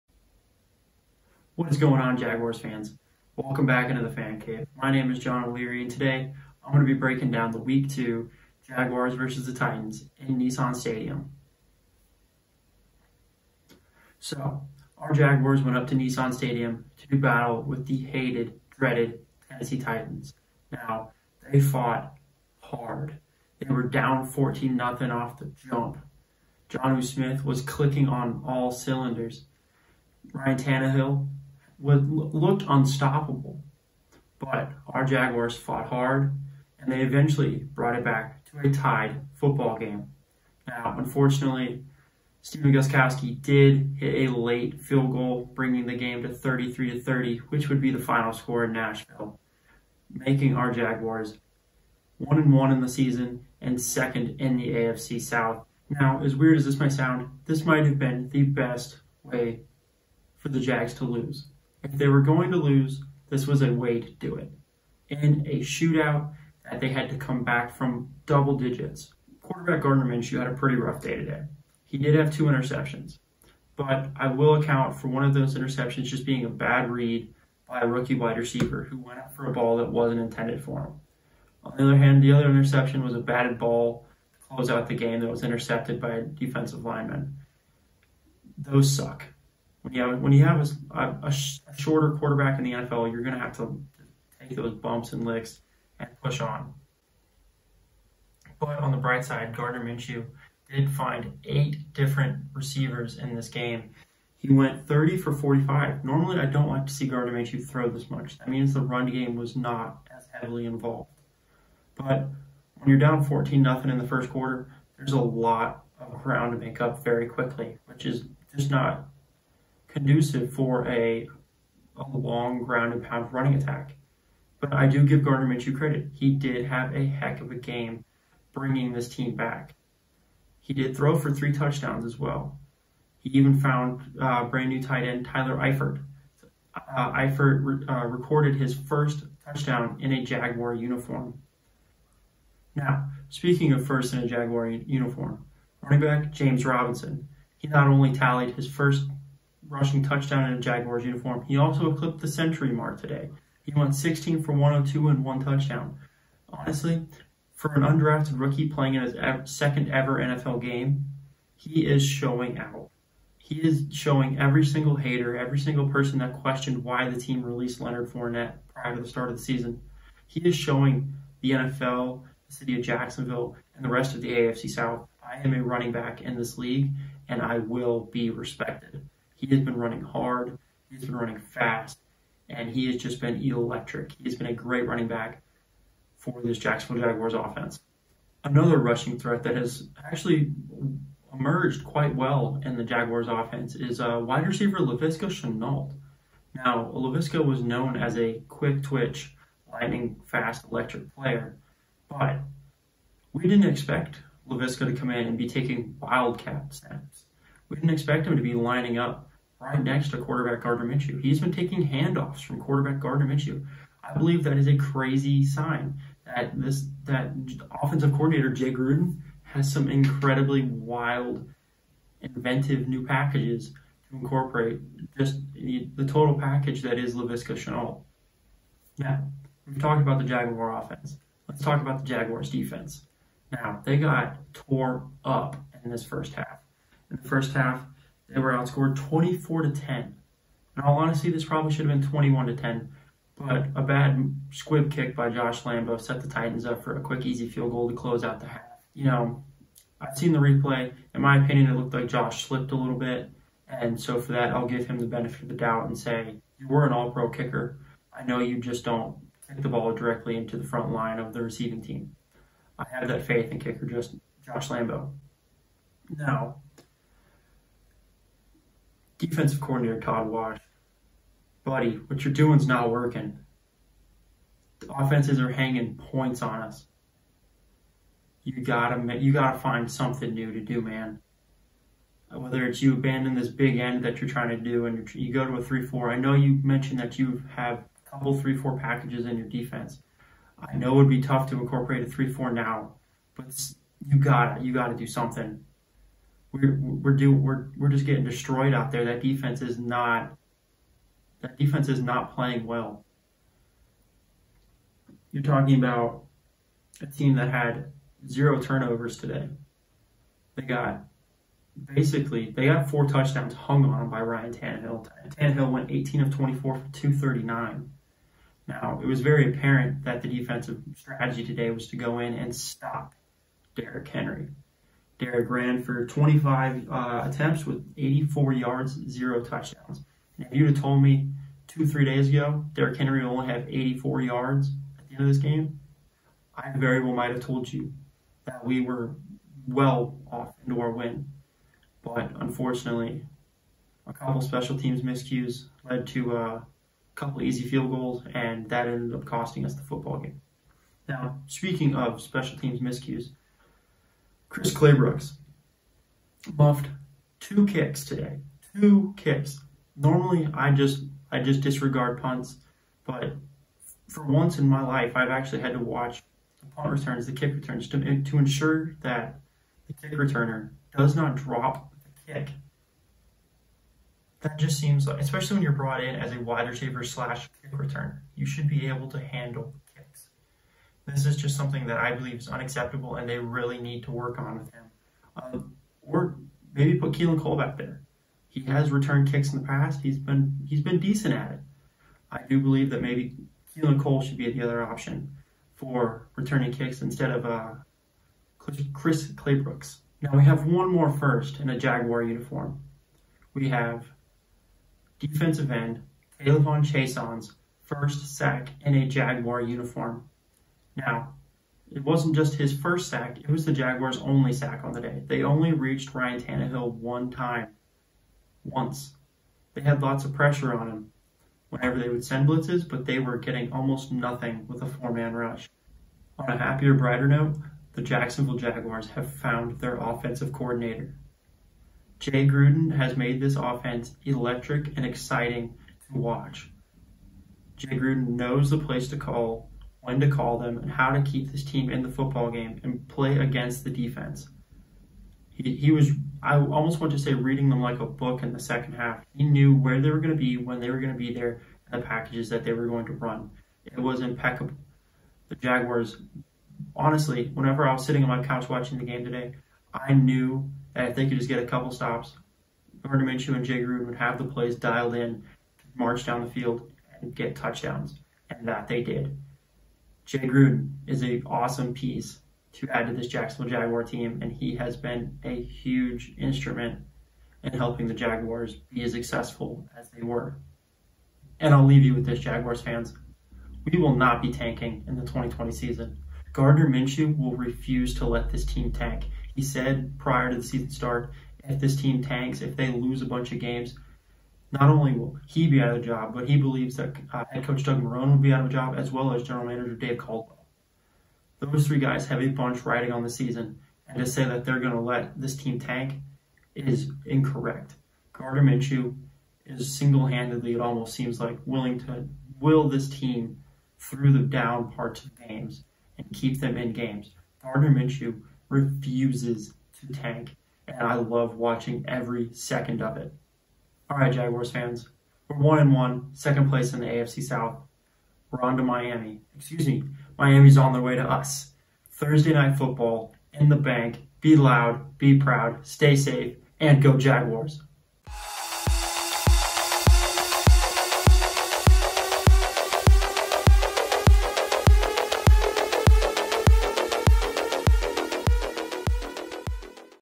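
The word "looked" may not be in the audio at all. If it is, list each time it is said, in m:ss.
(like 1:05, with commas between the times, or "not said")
0:32, 4:11.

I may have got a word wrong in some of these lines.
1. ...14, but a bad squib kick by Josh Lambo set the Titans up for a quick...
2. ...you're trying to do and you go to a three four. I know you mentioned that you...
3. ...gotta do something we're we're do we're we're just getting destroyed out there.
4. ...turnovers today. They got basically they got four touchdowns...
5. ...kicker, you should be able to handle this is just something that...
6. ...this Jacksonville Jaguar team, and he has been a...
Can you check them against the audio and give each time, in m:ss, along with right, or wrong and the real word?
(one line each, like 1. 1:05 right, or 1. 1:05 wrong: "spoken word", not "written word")
1. 4:02 wrong: "10", not "14"
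2. 4:44 right
3. 4:54 right
4. 5:08 right
5. 6:17 wrong: "returner", not "kicker"
6. 7:53 right.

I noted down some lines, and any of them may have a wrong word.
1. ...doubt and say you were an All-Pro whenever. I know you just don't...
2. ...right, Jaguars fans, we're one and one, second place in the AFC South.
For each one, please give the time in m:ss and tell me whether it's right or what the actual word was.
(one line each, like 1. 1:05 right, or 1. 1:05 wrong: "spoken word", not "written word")
1. 4:15 wrong: "kicker", not "whenever"
2. 8:44 right.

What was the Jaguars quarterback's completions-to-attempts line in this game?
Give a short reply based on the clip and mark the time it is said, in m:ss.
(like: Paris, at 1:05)
30 for 45, at 1:44.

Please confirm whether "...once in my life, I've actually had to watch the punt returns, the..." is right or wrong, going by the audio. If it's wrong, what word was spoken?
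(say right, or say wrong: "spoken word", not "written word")
right.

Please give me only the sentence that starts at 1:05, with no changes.
In a shootout that they had to come back from double digits.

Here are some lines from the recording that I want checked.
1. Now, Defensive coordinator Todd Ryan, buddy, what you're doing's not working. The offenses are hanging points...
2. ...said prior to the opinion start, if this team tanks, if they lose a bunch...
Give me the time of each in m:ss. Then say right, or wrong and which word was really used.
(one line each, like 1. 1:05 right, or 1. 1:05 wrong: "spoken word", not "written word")
1. 4:26 wrong: "Wash", not "Ryan"
2. 8:09 wrong: "season", not "opinion".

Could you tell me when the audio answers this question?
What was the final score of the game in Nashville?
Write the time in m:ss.
0:46.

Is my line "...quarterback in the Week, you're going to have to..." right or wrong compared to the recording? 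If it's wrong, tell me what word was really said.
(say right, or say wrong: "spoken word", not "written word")
wrong: "NFL", not "Week".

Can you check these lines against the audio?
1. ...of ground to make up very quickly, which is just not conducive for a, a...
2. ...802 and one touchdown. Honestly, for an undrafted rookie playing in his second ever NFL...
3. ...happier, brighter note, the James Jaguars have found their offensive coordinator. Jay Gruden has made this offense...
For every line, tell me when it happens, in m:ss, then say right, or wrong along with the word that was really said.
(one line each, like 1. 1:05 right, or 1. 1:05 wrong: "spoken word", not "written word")
1. 1:55 right
2. 2:34 wrong: "102", not "802"
3. 7:06 wrong: "Jacksonville", not "James".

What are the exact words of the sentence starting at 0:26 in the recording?
Jonnu Smith was clicking on all cylinders.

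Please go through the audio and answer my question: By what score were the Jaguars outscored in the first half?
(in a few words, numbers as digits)
24 to 10.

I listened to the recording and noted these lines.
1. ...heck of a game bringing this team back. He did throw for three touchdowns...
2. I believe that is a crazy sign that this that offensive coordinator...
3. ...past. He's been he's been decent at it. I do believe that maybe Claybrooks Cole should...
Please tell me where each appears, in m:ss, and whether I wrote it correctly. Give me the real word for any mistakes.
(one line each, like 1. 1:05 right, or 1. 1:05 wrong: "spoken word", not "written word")
1. 2:07 right
2. 3:34 right
3. 6:29 wrong: "Keelan", not "Claybrooks".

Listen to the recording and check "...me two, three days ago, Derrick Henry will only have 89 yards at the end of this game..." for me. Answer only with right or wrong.
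wrong.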